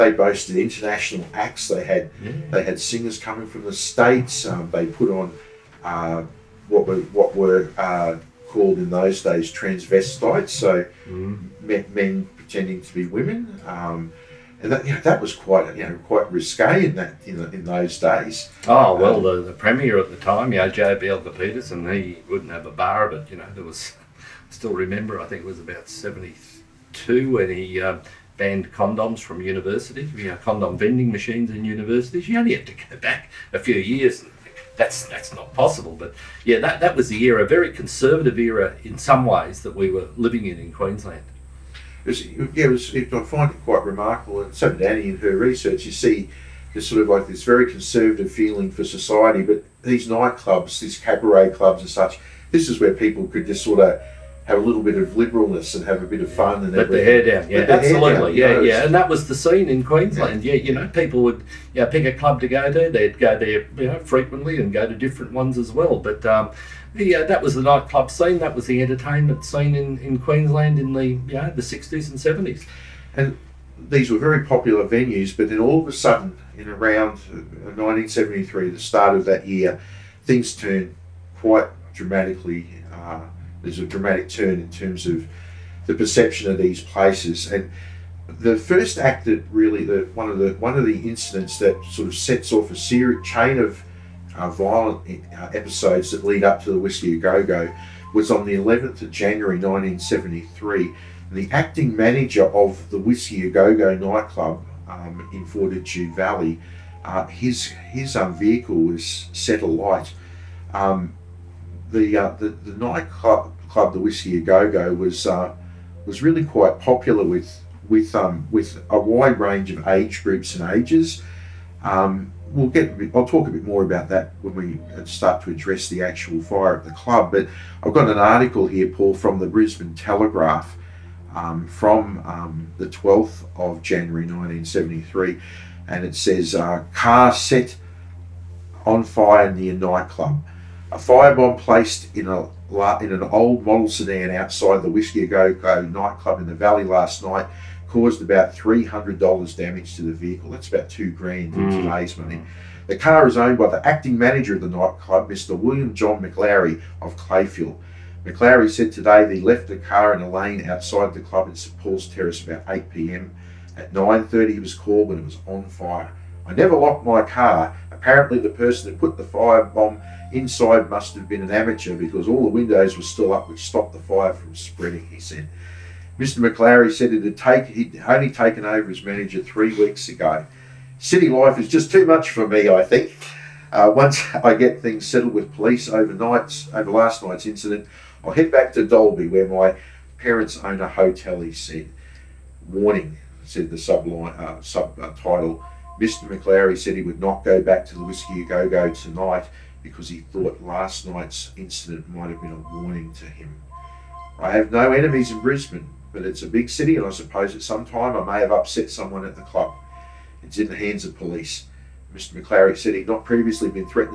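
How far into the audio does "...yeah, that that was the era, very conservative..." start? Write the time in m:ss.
0:36.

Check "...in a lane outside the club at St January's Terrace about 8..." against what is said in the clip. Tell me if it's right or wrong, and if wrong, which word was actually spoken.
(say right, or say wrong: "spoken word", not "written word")
wrong: "Paul", not "January".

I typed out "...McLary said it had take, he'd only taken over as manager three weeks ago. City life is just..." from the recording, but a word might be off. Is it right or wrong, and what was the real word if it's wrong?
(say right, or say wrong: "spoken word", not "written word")
right.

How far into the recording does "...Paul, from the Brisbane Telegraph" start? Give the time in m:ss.
2:08.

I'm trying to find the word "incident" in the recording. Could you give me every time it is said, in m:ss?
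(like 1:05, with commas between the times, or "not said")
1:31, 3:07, 3:21.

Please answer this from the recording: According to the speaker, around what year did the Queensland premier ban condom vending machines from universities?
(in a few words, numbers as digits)
1972.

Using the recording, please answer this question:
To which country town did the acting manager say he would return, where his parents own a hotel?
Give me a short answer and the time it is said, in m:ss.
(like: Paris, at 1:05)
Dalby, at 3:08.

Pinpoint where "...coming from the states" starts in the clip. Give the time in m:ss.
0:03.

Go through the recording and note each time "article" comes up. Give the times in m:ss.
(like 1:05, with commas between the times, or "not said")
2:08.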